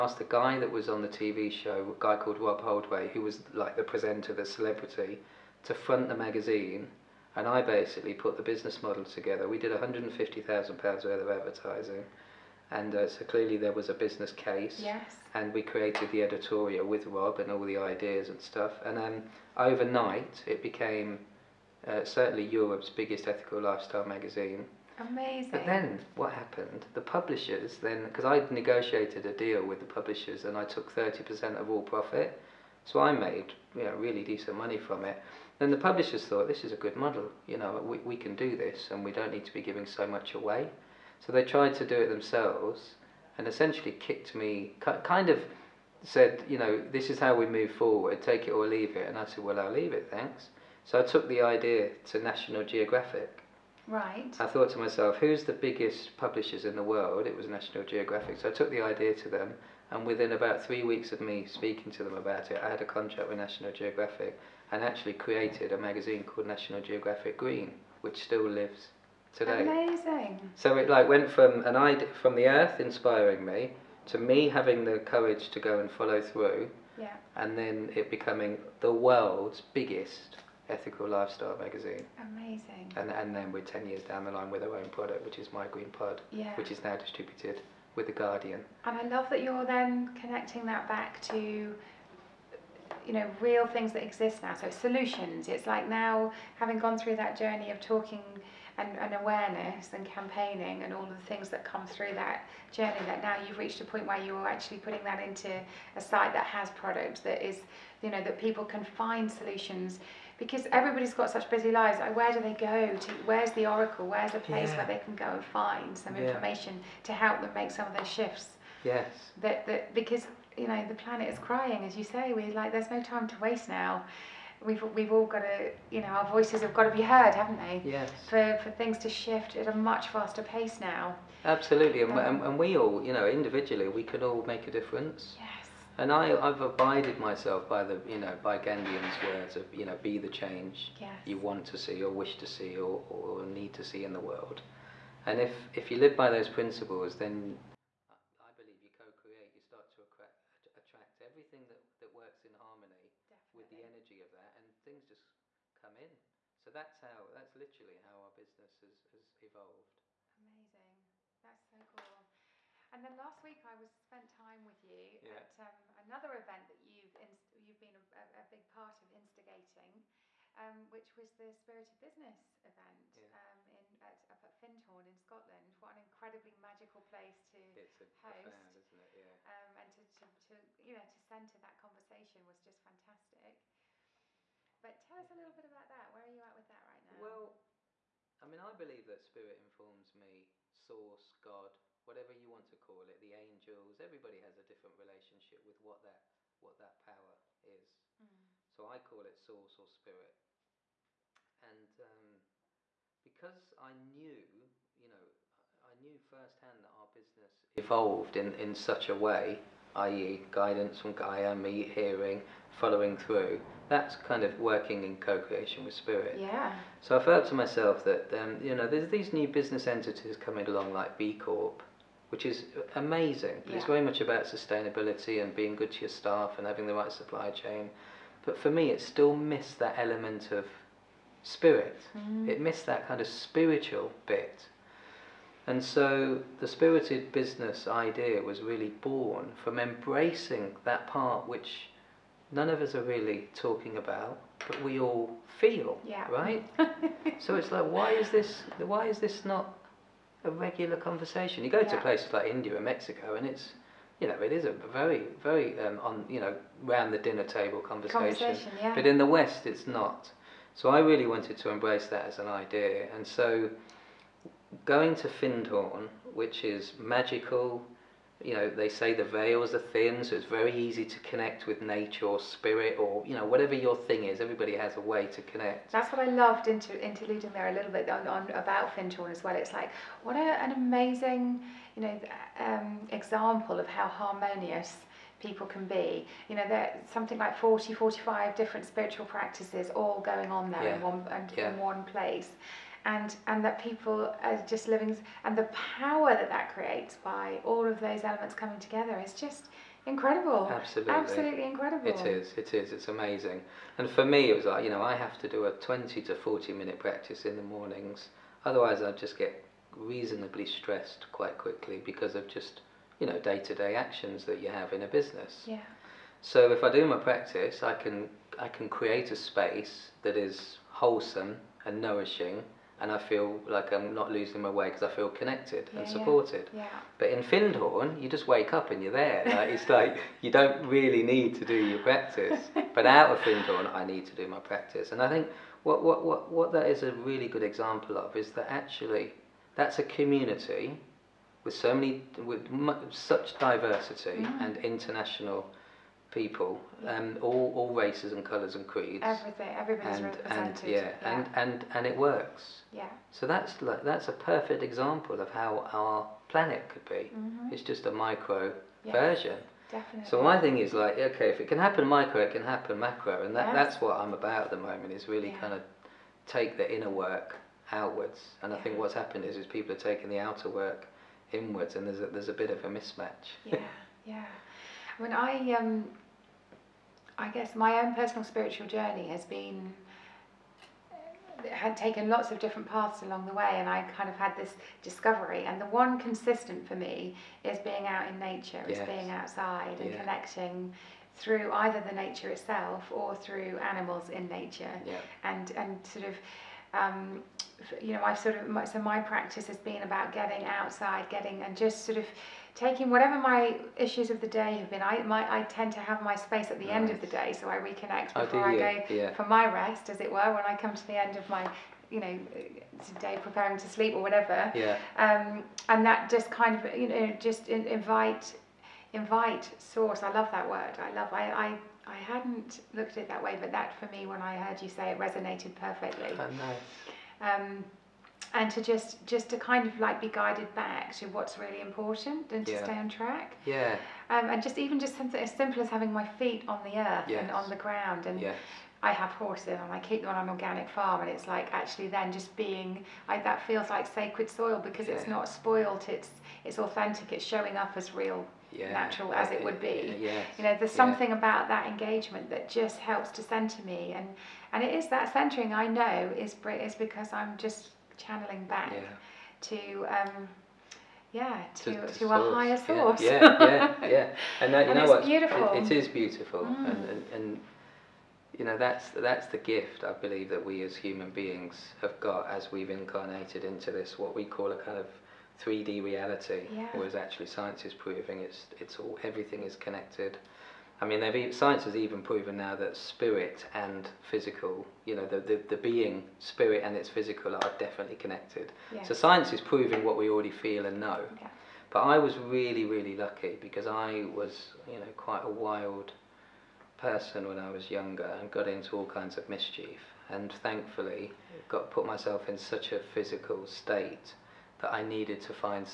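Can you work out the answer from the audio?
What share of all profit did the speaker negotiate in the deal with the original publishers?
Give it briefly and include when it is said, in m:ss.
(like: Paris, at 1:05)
30%, at 0:30.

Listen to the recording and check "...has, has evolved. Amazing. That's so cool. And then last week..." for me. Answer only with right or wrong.
right.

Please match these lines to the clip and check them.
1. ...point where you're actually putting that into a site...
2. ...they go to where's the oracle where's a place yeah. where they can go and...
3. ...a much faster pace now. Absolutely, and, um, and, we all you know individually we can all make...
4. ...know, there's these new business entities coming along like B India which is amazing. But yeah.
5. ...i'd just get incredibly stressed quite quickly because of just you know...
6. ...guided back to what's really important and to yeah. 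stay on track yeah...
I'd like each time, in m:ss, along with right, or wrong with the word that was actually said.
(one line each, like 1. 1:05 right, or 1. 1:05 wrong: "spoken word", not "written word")
1. 1:43 right
2. 1:52 right
3. 2:09 right
4. 3:38 wrong: "Corp", not "India"
5. 5:09 wrong: "reasonably", not "incredibly"
6. 7:10 right.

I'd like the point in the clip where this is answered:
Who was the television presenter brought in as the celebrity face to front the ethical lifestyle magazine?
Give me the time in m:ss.
0:02.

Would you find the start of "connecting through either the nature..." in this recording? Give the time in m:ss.
6:30.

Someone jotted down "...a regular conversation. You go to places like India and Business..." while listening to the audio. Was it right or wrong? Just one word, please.
wrong.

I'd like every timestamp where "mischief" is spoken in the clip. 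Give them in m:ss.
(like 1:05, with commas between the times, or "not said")
8:19.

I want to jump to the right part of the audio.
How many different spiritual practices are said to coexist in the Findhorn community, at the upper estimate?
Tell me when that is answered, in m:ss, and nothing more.
4:47.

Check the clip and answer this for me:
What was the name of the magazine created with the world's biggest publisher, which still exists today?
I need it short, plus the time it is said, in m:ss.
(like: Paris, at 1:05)
National Geographic Green, at 1:06.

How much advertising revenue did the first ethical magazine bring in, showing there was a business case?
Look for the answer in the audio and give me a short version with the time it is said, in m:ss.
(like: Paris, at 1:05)
£150,000, at 0:09.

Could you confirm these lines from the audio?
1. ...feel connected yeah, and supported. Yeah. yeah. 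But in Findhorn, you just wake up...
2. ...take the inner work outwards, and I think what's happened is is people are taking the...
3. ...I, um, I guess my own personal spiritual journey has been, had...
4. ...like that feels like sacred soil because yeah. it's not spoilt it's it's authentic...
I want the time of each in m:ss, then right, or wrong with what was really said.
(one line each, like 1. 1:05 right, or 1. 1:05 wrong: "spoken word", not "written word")
1. 5:25 right
2. 6:06 right
3. 6:15 right
4. 7:23 right.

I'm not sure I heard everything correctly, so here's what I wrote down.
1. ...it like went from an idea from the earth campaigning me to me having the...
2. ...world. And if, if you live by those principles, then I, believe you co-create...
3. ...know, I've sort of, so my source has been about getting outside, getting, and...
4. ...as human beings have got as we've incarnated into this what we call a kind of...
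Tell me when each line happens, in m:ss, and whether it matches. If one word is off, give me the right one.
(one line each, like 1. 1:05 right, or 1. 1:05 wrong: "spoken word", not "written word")
1. 1:10 wrong: "inspiring", not "campaigning"
2. 2:24 right
3. 6:38 wrong: "practice", not "source"
4. 7:50 right.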